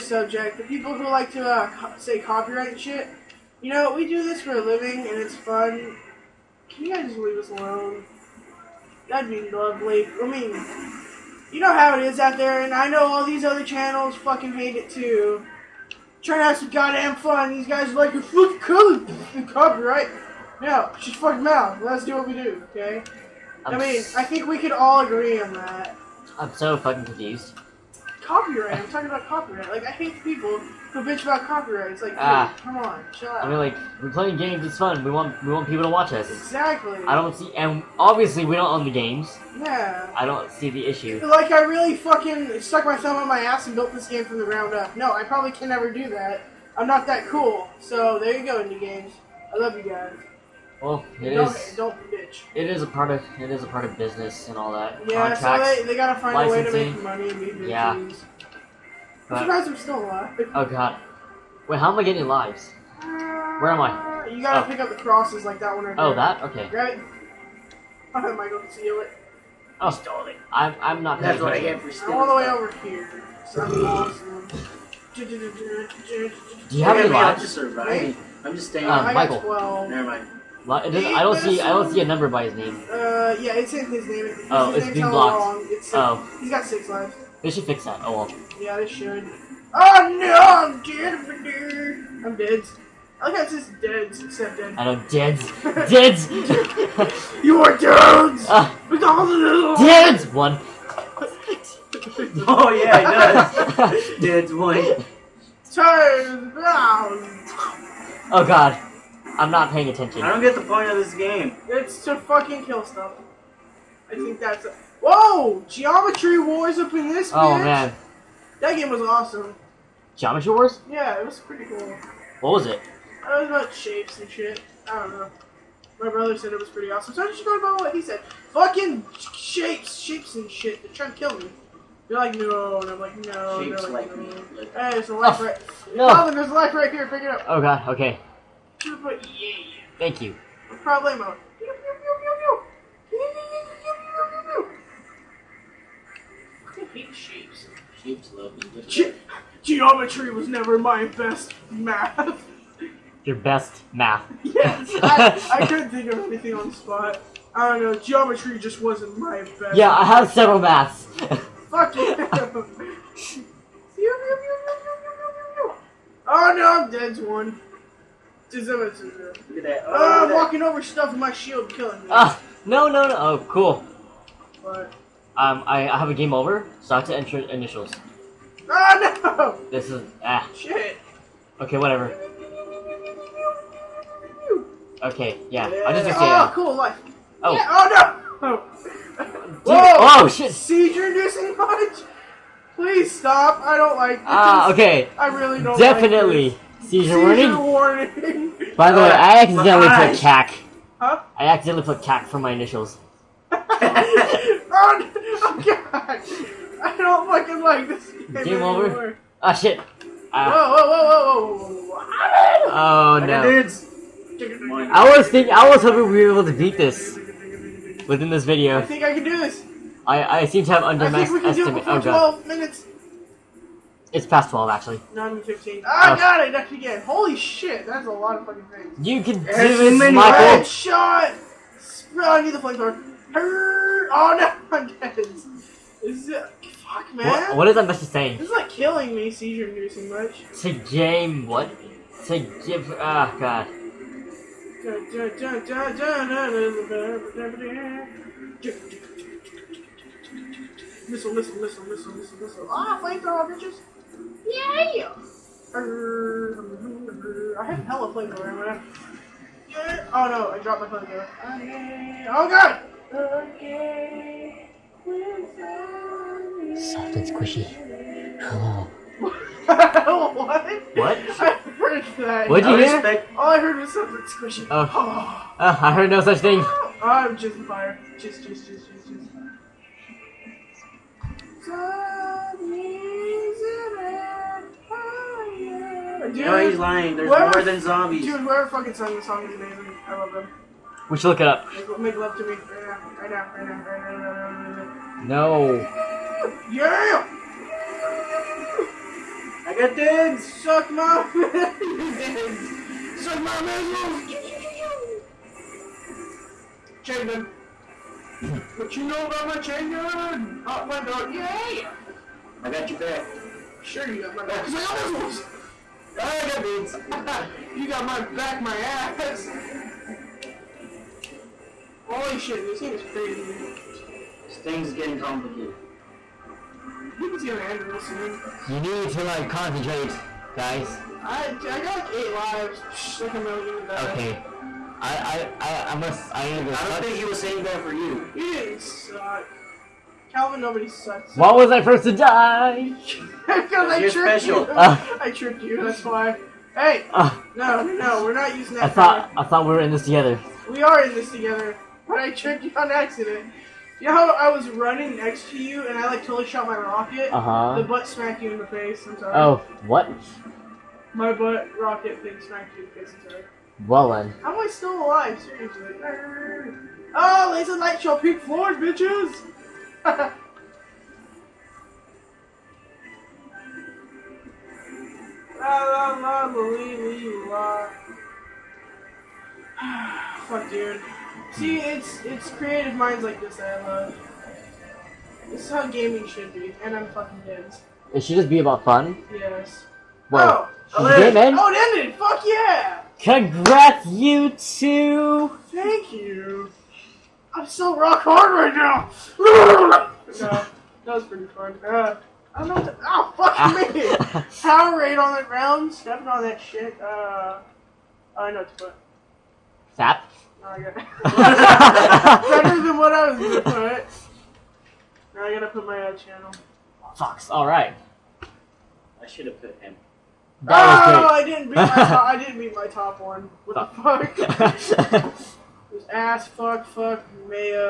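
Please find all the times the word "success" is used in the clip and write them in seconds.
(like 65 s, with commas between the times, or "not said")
not said.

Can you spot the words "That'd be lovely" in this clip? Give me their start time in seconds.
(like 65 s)
9 s.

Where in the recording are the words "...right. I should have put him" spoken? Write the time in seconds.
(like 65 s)
417 s.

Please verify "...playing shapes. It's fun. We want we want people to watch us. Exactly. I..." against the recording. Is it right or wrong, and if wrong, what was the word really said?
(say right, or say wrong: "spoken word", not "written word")
wrong: "games", not "shapes".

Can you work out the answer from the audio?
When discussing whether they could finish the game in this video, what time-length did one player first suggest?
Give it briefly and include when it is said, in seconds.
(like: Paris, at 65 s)
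12 minutes, at 222 s.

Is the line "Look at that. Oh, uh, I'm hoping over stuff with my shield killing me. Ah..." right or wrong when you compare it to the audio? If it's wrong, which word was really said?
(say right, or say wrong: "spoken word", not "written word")
wrong: "walking", not "hoping".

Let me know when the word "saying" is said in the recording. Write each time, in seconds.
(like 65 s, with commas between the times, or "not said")
238 s, 337 s.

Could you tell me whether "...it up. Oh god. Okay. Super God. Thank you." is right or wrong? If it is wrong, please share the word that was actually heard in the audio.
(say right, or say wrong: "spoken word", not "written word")
wrong: "Yay", not "God".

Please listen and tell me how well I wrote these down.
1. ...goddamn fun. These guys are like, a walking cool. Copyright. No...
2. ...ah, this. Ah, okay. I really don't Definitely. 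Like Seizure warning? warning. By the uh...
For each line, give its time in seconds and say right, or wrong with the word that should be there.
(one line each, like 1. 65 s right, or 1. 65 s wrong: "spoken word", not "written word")
1. 16 s wrong: "fucking", not "walking"
2. 194 s right.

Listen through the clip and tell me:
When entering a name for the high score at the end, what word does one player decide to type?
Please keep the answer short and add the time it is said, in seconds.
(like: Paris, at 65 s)
Sap, at 409 s.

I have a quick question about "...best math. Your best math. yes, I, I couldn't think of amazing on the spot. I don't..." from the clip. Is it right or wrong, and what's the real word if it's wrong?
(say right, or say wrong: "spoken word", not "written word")
wrong: "anything", not "amazing".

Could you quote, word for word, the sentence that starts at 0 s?
The people who like to uh, say copyright shit.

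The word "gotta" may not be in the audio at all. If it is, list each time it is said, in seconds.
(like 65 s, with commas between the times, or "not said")
55 s, 64 s, 415 s.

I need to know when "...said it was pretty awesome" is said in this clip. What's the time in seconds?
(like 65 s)
126 s.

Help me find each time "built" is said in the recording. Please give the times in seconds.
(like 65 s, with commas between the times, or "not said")
43 s.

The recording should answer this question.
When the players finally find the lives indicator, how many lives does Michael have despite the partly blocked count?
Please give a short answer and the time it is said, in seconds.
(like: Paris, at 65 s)
6, at 86 s.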